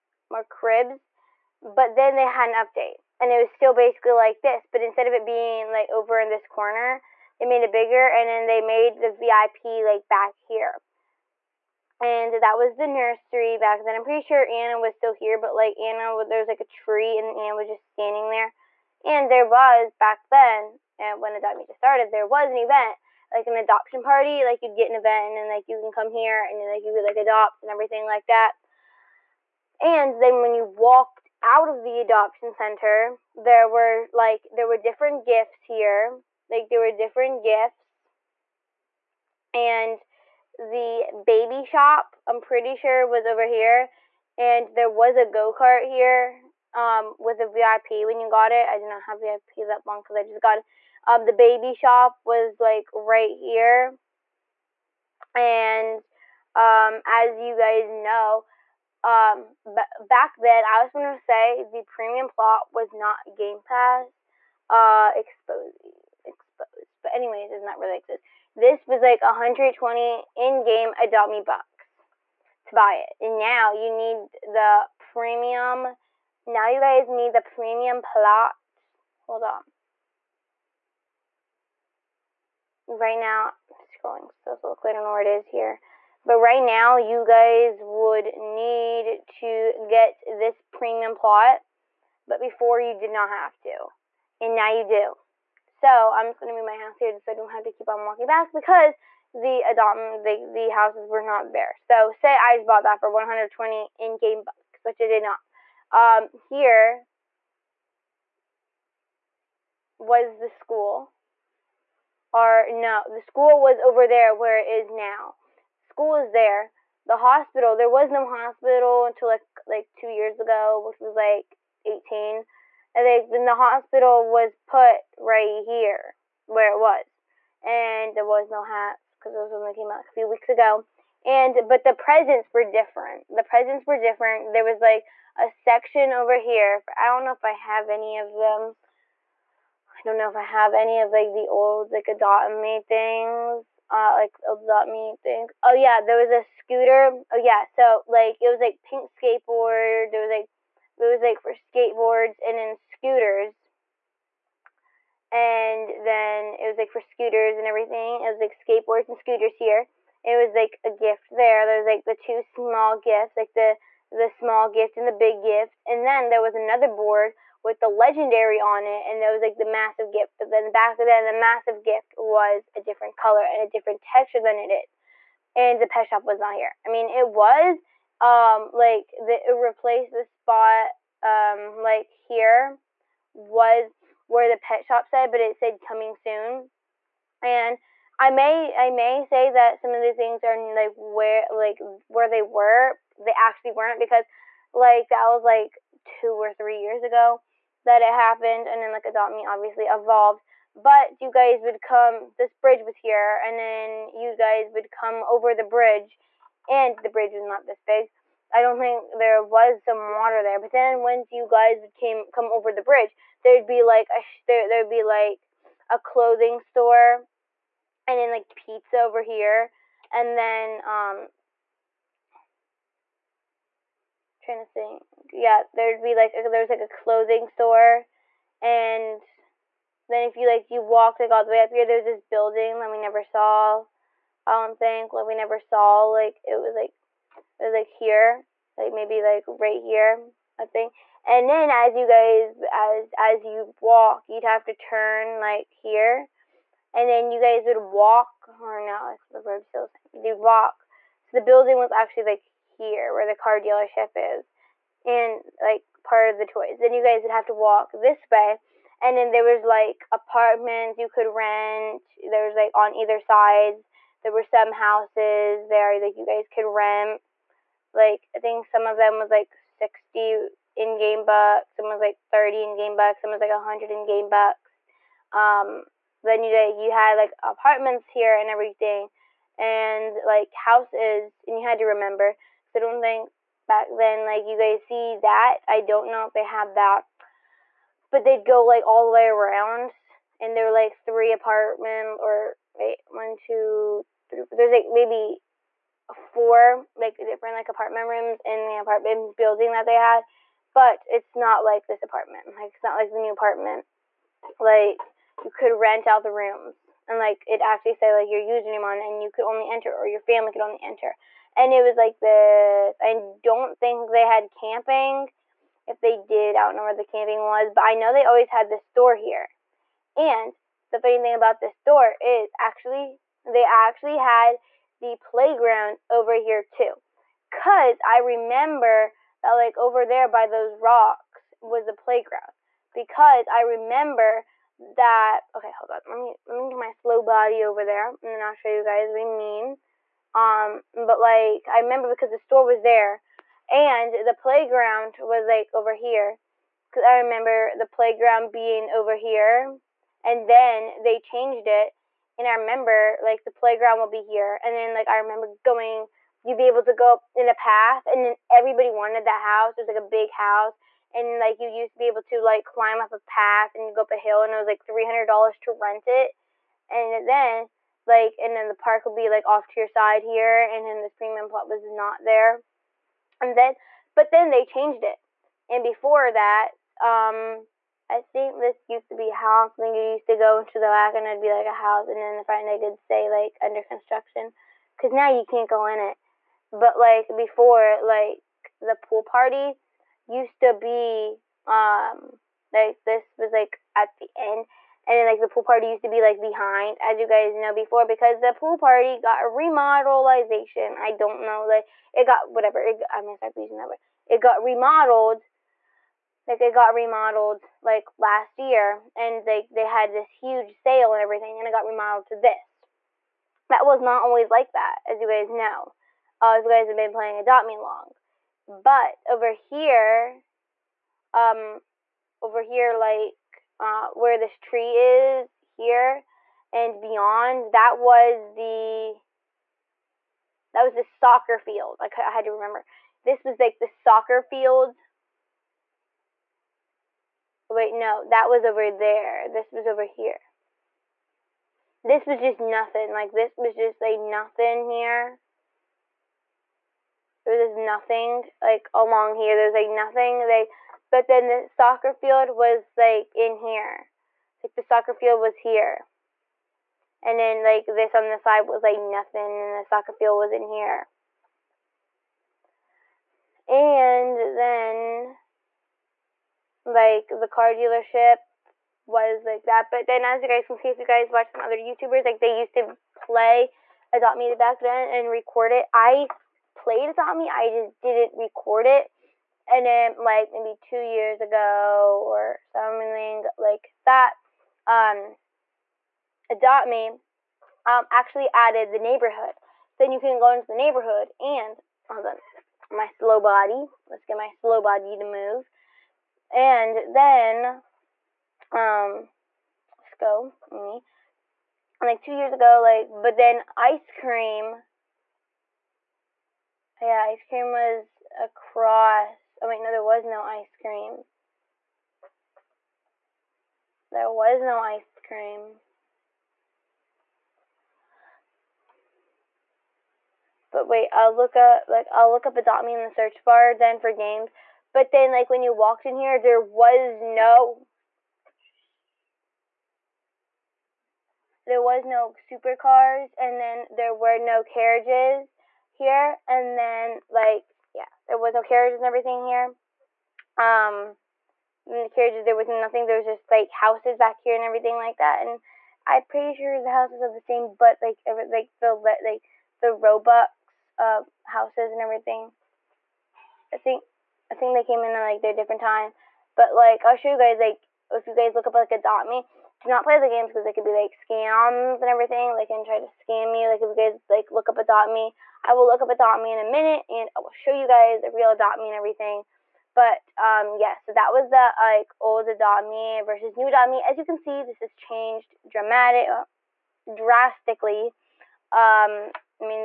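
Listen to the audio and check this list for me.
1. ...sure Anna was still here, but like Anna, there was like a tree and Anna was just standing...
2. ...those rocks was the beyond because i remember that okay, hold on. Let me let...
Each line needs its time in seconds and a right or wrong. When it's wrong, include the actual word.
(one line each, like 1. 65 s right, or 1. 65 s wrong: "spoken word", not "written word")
1. 14 s right
2. 330 s wrong: "playground", not "beyond".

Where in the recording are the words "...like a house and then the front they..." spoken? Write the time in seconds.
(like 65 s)
381 s.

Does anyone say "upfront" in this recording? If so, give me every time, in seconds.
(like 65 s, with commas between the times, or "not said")
not said.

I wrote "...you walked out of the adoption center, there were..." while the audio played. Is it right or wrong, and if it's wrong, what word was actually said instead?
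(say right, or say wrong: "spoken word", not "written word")
right.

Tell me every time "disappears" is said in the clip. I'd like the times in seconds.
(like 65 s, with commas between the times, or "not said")
not said.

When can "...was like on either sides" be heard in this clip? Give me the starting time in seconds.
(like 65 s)
262 s.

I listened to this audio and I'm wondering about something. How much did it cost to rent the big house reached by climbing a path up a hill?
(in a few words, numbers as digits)
$300.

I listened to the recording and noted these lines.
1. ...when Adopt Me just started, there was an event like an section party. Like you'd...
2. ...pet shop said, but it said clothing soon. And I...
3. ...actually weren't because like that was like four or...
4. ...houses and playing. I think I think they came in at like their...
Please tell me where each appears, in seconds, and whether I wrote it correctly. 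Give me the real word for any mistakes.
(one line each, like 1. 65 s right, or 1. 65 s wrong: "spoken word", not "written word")
1. 21 s wrong: "adoption", not "section"
2. 184 s wrong: "coming", not "clothing"
3. 193 s wrong: "two", not "four"
4. 551 s wrong: "everything", not "playing".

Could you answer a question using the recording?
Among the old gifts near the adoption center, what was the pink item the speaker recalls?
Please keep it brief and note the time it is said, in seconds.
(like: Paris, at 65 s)
skateboard, at 148 s.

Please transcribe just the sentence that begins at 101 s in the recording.
So say I just bought that for 120 in-game bucks, which I did not.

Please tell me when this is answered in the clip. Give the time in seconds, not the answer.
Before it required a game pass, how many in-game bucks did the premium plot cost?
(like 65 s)
69 s.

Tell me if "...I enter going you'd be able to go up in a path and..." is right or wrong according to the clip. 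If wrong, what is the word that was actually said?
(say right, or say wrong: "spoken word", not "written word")
wrong: "remember", not "enter".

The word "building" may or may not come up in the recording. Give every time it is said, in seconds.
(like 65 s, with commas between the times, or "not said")
232 s, 251 s, 299 s.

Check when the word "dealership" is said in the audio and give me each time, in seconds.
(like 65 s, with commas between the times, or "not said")
253 s, 467 s.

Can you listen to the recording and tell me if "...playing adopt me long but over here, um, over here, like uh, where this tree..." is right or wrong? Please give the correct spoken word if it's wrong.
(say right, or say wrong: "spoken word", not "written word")
right.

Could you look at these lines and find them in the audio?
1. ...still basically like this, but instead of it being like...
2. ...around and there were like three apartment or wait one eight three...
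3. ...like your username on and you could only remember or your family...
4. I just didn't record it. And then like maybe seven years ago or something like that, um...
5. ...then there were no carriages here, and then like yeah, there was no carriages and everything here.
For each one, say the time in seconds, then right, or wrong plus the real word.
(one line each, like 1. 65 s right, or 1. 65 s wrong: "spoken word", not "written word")
1. 3 s right
2. 289 s wrong: "two", not "eight"
3. 308 s wrong: "enter", not "remember"
4. 477 s wrong: "two", not "seven"
5. 533 s right.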